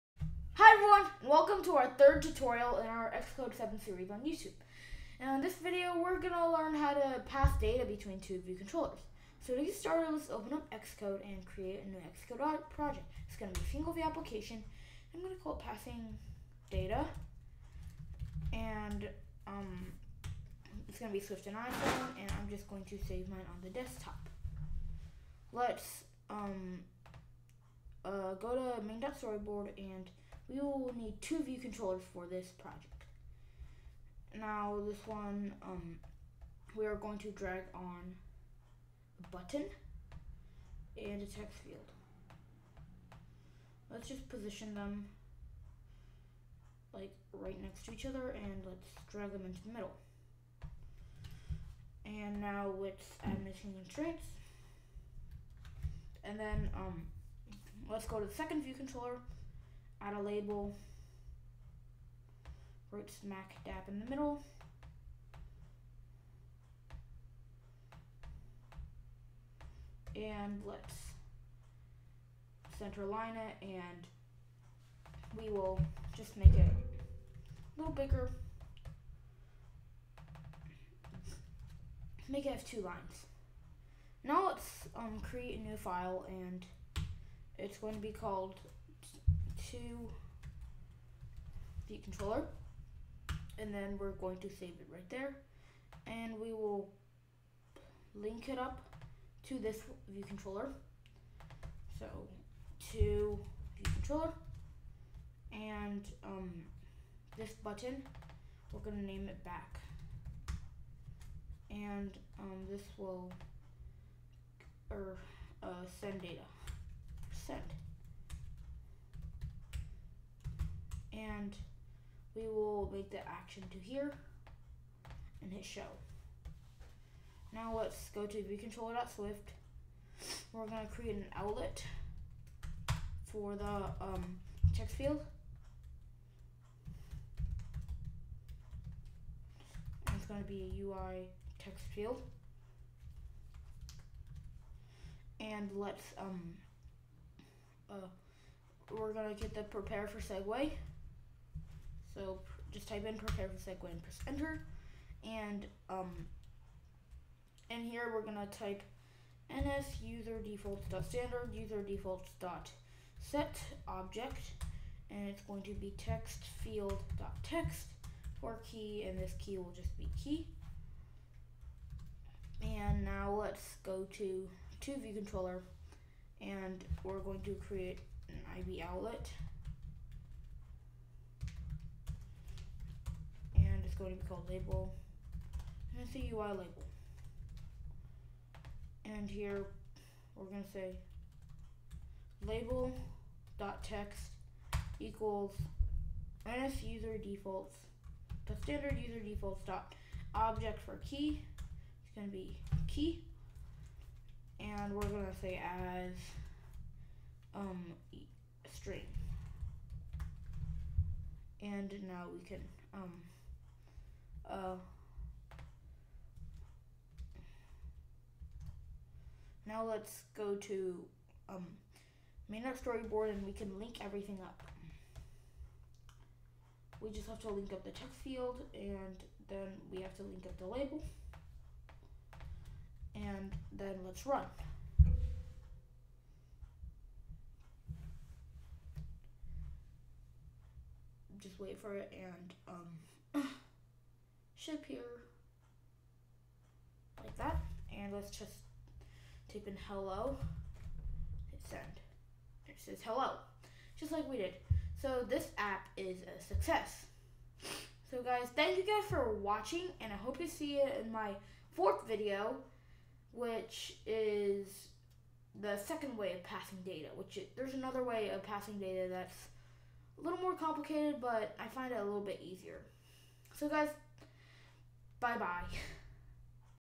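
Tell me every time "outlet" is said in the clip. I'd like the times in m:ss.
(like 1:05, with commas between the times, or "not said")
2:11, 2:58.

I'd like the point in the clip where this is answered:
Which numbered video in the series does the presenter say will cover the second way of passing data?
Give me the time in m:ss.
4:21.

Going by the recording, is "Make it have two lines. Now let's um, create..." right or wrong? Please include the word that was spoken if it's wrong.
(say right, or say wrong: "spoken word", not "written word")
right.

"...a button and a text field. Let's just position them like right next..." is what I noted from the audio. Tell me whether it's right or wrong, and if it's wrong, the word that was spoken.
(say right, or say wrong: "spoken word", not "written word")
right.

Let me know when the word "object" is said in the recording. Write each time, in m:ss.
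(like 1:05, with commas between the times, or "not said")
2:43, 3:20.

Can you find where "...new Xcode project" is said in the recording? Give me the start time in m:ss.
0:11.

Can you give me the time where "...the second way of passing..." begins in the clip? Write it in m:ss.
4:25.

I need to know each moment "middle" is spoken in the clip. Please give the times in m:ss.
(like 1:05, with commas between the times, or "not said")
0:49, 1:04.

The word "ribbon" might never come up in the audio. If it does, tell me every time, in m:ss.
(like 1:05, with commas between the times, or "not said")
not said.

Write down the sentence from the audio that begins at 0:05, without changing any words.
Now in this video, we're going to learn how to pass data between two view controllers.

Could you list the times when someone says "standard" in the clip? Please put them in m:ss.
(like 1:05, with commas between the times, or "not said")
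2:41, 3:18.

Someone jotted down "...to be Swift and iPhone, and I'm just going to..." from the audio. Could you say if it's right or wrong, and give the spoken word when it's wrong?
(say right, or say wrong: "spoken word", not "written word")
right.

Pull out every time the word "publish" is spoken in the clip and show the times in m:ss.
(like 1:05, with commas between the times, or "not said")
not said.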